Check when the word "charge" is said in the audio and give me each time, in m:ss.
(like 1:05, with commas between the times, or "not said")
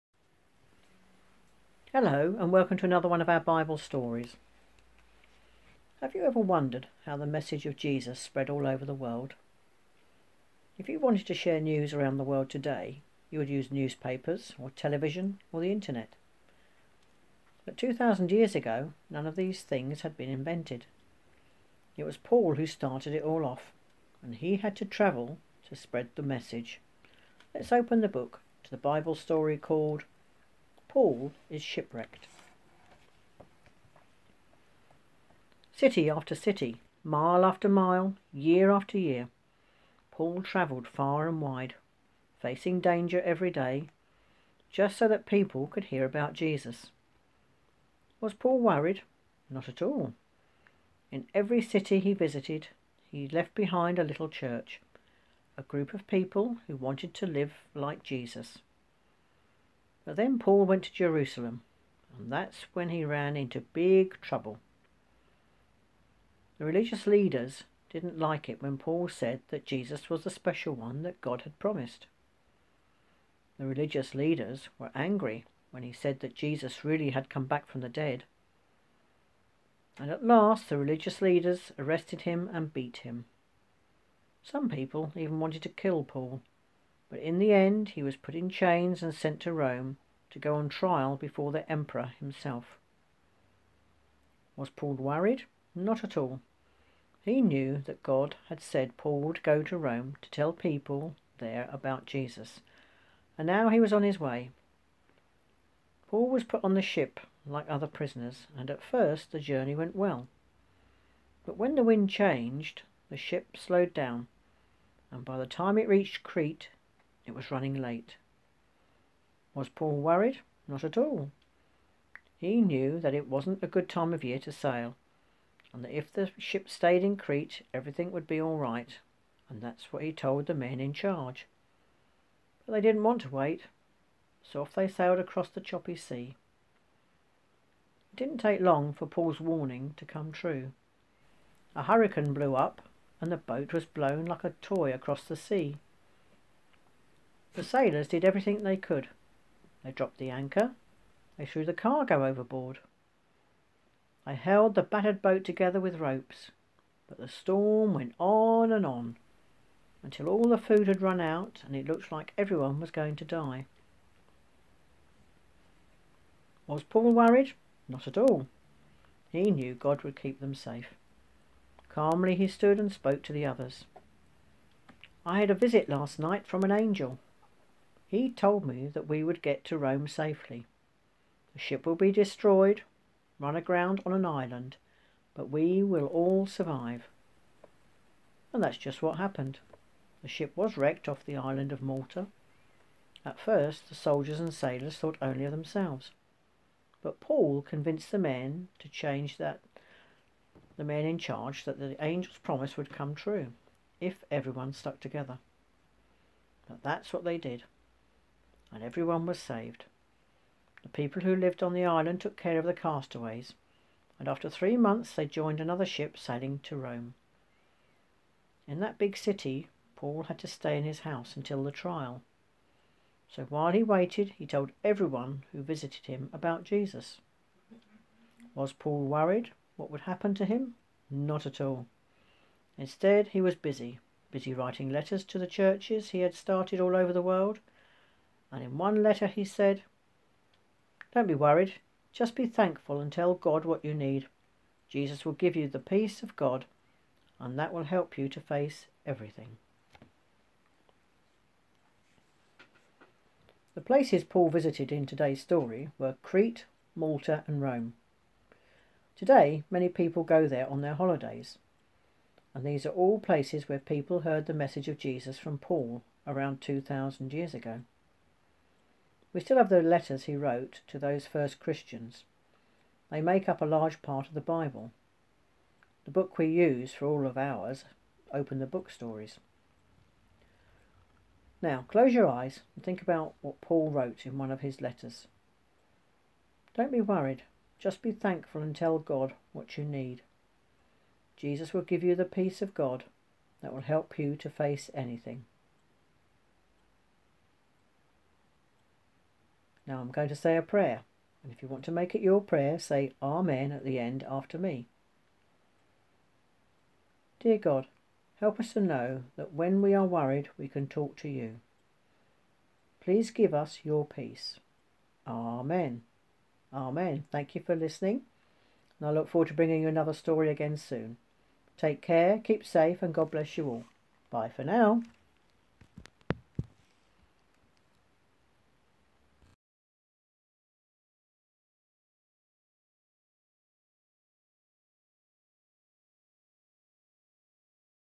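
2:10, 3:21.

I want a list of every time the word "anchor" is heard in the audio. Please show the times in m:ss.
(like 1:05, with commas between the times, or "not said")
2:30.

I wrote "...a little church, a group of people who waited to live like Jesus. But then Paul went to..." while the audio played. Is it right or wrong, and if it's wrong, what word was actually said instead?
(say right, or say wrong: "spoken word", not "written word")
wrong: "wanted", not "waited".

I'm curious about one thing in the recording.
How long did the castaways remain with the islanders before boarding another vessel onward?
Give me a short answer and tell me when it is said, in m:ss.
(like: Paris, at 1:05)
3 months, at 3:34.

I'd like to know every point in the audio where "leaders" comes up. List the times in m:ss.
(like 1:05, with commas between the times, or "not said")
1:07, 1:14, 1:21.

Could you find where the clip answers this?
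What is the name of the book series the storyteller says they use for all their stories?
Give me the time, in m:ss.
4:38.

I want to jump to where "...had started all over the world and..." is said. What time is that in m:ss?
3:56.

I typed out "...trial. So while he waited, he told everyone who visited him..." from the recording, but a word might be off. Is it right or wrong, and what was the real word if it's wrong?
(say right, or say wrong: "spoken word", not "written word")
right.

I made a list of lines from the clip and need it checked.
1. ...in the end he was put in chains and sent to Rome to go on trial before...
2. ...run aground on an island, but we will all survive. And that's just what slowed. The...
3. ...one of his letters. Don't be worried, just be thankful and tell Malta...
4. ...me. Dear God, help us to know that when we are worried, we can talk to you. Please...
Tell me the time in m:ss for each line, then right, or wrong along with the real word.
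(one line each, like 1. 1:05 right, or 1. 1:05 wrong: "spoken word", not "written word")
1. 1:27 right
2. 3:03 wrong: "happened", not "slowed"
3. 4:44 wrong: "God", not "Malta"
4. 5:04 right.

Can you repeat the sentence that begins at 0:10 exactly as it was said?
If you wanted to share news around the world today, you would use newspapers or television or the internet.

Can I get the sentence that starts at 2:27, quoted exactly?
The sailors did everything they could.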